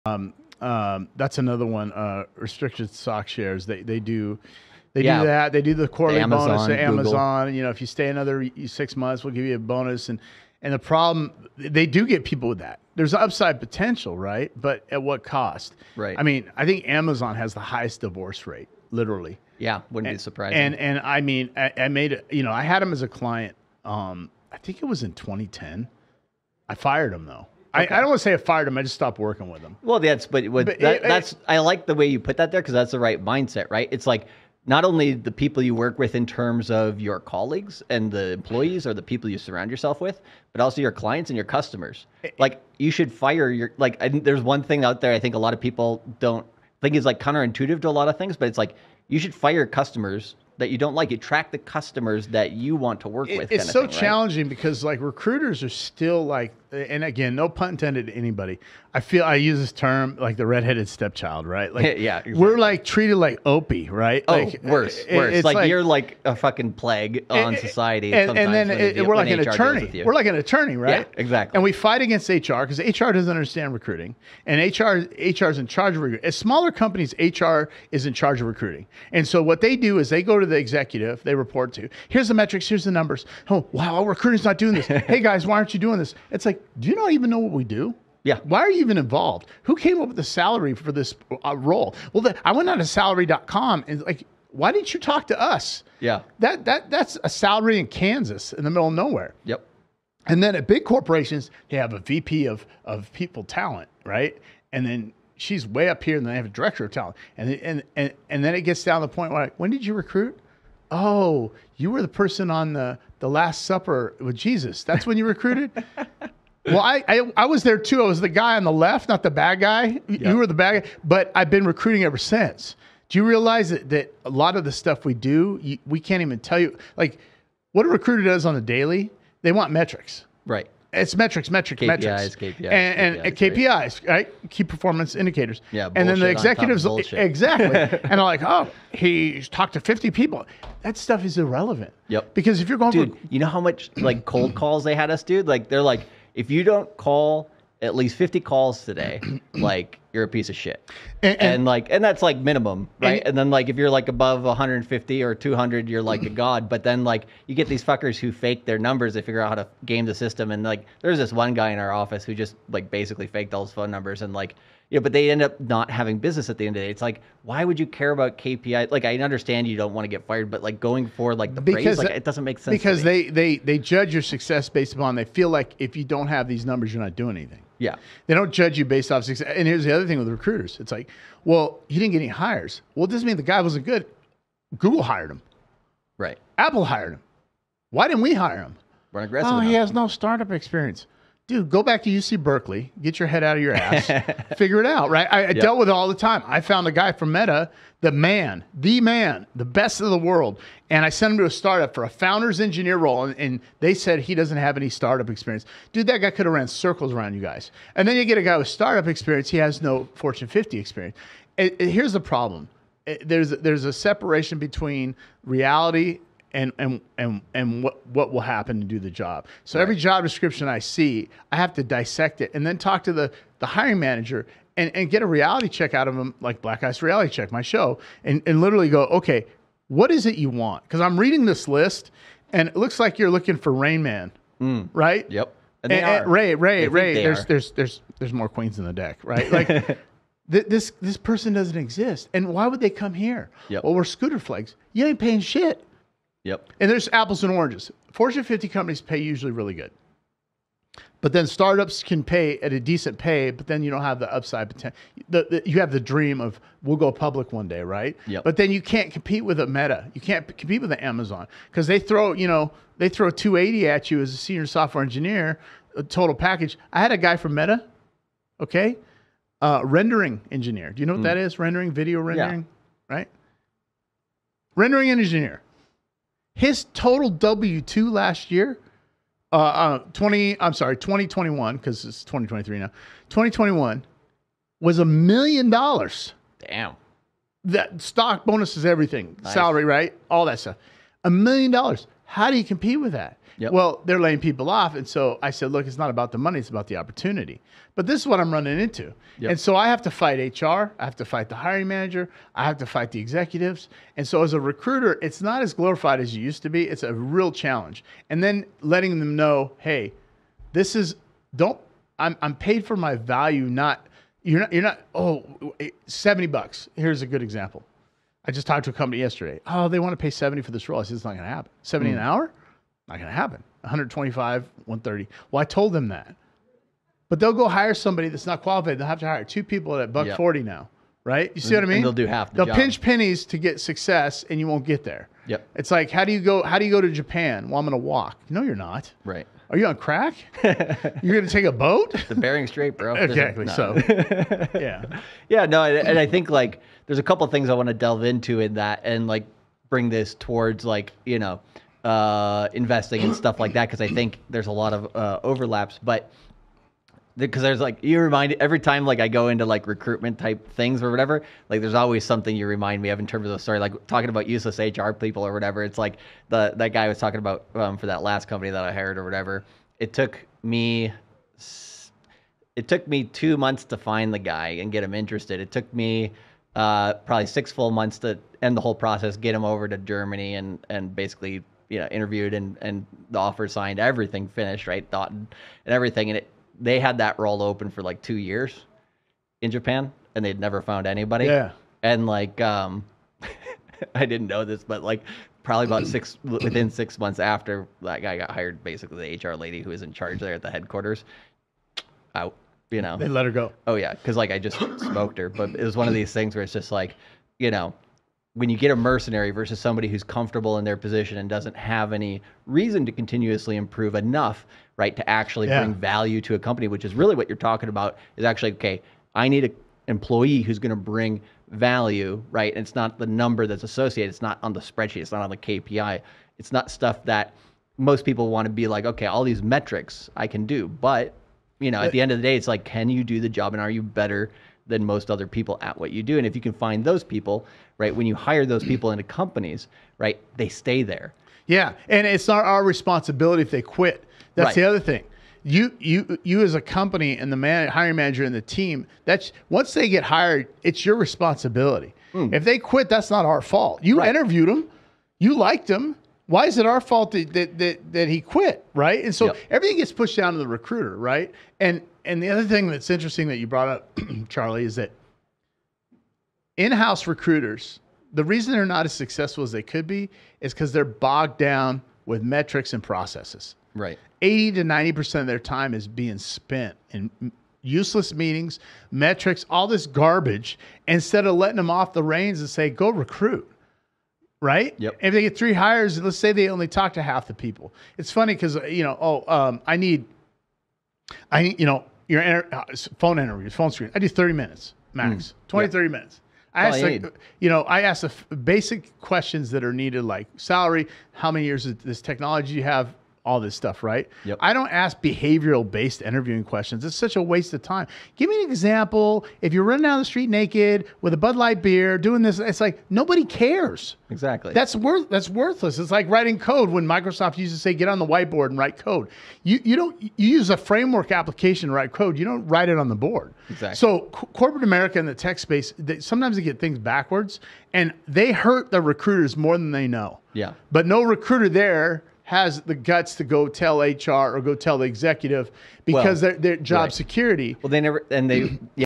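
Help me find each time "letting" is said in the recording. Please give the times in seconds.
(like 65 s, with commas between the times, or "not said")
308 s, 481 s.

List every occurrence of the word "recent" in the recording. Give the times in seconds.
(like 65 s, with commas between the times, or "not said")
not said.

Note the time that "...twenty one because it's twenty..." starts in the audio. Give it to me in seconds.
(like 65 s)
281 s.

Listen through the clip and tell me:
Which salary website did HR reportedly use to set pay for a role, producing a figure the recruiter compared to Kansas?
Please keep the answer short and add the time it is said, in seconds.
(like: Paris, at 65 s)
salary.com, at 92 s.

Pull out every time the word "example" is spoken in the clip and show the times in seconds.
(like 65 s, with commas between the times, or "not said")
317 s, 508 s.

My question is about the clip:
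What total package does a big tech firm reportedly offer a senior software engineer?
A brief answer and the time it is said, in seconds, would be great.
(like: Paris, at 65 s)
280, at 263 s.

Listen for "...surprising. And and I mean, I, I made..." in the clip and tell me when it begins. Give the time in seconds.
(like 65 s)
20 s.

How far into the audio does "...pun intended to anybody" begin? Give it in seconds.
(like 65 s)
57 s.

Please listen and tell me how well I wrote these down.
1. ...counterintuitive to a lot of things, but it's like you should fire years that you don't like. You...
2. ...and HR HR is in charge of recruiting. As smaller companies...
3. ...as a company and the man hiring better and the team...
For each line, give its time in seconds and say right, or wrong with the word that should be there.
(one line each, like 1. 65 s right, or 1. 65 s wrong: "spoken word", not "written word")
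1. 47 s wrong: "customers", not "years"
2. 74 s right
3. 446 s wrong: "manager", not "better".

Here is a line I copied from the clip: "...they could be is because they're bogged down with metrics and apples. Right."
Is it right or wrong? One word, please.
wrong.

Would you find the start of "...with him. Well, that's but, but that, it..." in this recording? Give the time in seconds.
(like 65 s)
29 s.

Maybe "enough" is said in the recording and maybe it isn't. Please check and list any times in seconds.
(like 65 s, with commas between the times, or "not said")
189 s, 414 s.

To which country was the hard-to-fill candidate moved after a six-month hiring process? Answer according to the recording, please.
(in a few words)
Germany.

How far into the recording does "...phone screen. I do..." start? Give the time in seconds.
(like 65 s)
493 s.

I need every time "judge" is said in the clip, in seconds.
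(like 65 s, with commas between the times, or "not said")
173 s, 178 s.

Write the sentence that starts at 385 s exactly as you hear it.
Thought and everything, and it they had that role open for like two years in Japan, and they'd never found anybody.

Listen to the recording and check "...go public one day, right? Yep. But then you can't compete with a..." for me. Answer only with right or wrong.
right.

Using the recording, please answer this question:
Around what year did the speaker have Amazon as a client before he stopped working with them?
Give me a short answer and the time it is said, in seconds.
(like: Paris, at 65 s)
2010, at 25 s.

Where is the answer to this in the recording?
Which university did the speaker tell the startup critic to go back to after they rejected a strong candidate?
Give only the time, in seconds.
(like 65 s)
192 s.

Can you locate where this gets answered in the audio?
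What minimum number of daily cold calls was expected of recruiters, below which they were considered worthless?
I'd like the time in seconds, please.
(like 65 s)
148 s.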